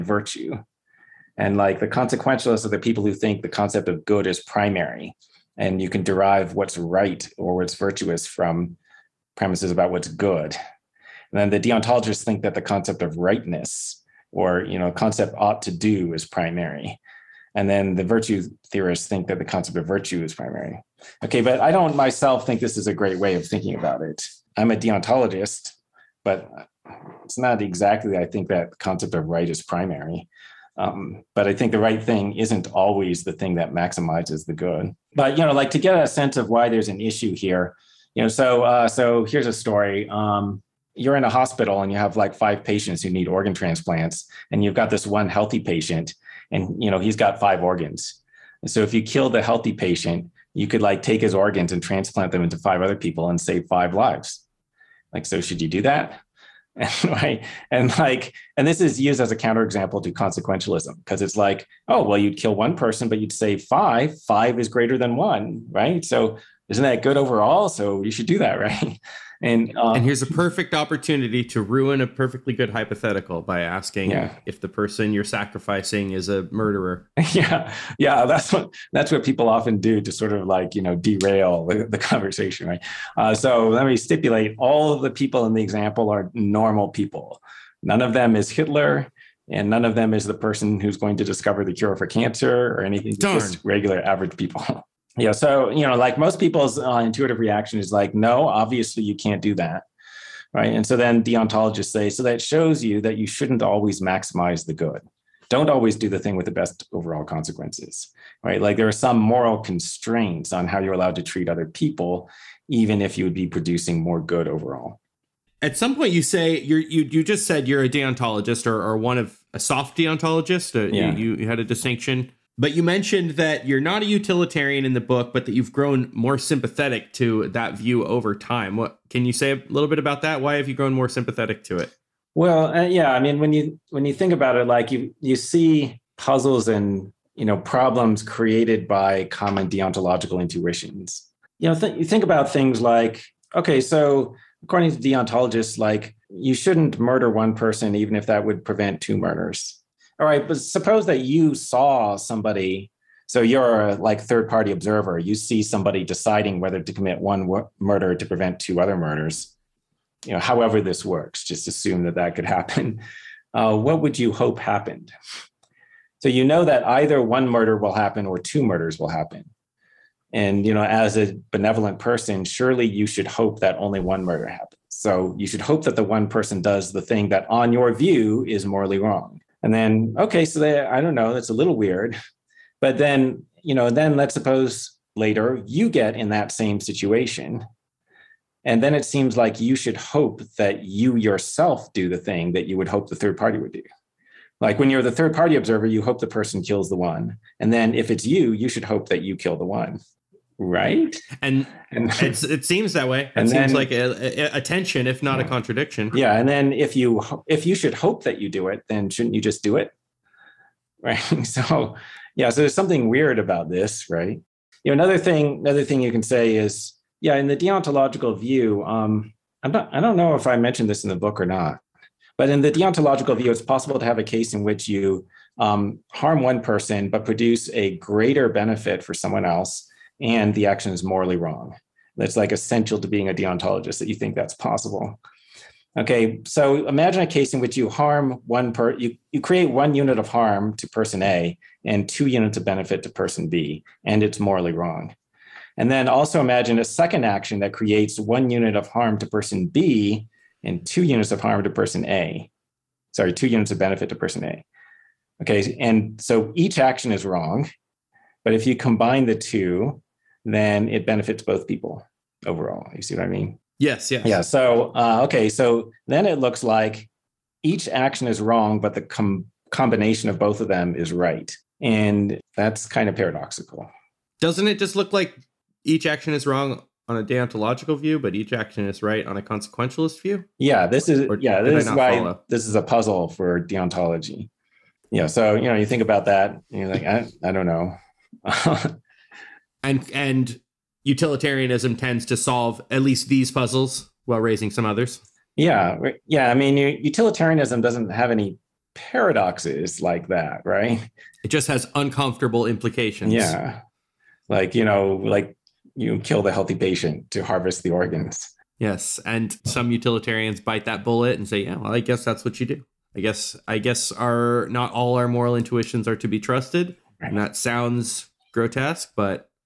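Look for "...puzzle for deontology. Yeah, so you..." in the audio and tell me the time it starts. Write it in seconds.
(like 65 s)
282 s.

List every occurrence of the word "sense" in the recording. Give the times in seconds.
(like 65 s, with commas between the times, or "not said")
36 s.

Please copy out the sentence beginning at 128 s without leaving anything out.
What can you say a little bit about that?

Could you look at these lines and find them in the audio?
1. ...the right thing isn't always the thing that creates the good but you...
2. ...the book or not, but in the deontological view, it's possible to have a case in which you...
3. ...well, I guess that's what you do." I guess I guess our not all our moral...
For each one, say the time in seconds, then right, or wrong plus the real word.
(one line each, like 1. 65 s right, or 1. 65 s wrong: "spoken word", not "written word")
1. 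31 s wrong: "maximizes", not "creates"
2. 221 s right
3. 311 s right.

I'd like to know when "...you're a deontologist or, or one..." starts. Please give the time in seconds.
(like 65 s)
117 s.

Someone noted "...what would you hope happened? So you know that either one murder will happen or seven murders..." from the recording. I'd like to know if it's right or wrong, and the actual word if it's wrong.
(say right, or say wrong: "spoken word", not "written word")
wrong: "two", not "seven".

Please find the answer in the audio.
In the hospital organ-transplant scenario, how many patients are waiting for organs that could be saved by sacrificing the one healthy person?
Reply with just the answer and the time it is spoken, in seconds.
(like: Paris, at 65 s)
5, at 42 s.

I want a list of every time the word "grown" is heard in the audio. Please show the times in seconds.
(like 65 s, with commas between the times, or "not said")
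125 s, 130 s.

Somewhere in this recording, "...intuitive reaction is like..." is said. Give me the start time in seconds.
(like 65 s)
96 s.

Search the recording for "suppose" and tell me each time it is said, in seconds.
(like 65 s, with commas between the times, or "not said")
150 s, 184 s.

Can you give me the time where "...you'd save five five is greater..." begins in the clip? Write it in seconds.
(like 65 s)
63 s.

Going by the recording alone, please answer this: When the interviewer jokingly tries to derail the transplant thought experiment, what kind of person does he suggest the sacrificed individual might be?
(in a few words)
A murderer.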